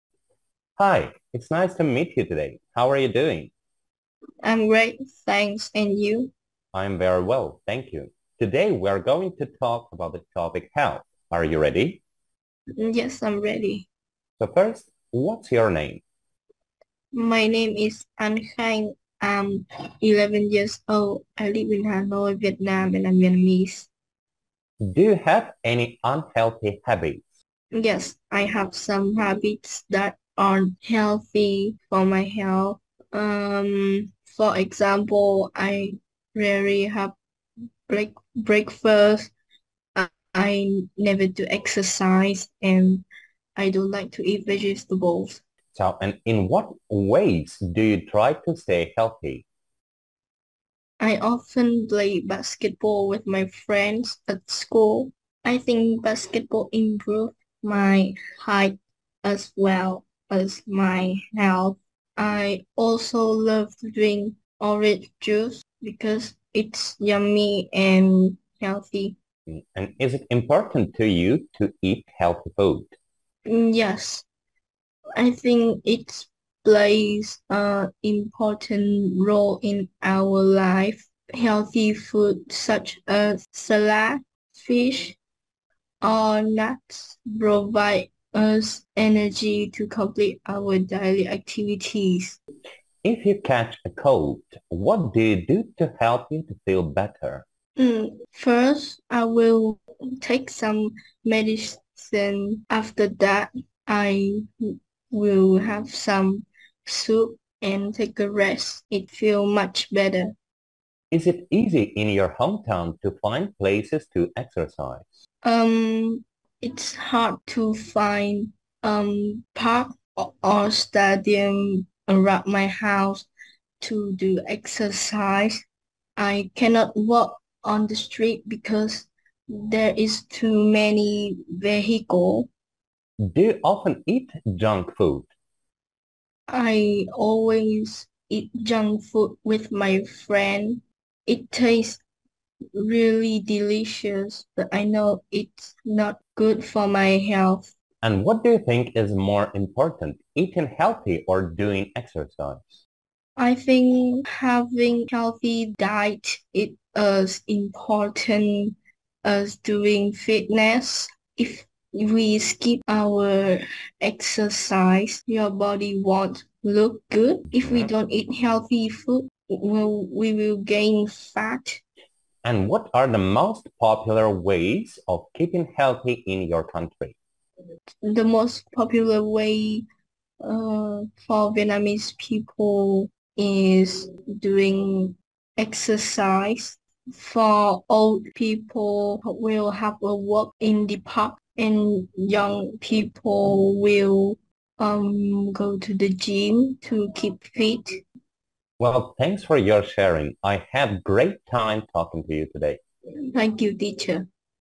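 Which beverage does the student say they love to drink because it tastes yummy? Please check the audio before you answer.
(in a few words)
Orange juice.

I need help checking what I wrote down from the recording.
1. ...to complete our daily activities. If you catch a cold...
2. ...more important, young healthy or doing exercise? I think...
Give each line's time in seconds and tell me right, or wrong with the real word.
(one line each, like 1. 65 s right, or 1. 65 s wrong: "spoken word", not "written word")
1. 89 s right
2. 149 s wrong: "eating", not "young".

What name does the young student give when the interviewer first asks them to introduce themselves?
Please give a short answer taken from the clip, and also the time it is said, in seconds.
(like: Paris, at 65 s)
An Khánh, at 18 s.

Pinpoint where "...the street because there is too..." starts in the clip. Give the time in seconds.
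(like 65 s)
127 s.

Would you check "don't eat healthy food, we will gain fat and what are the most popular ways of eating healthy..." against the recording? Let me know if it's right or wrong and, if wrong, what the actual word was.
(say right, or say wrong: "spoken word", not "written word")
wrong: "keeping", not "eating".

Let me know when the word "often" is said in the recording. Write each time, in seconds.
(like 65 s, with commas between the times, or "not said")
51 s, 133 s.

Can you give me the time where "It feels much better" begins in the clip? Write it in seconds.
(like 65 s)
108 s.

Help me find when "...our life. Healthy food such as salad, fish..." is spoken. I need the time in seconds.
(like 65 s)
80 s.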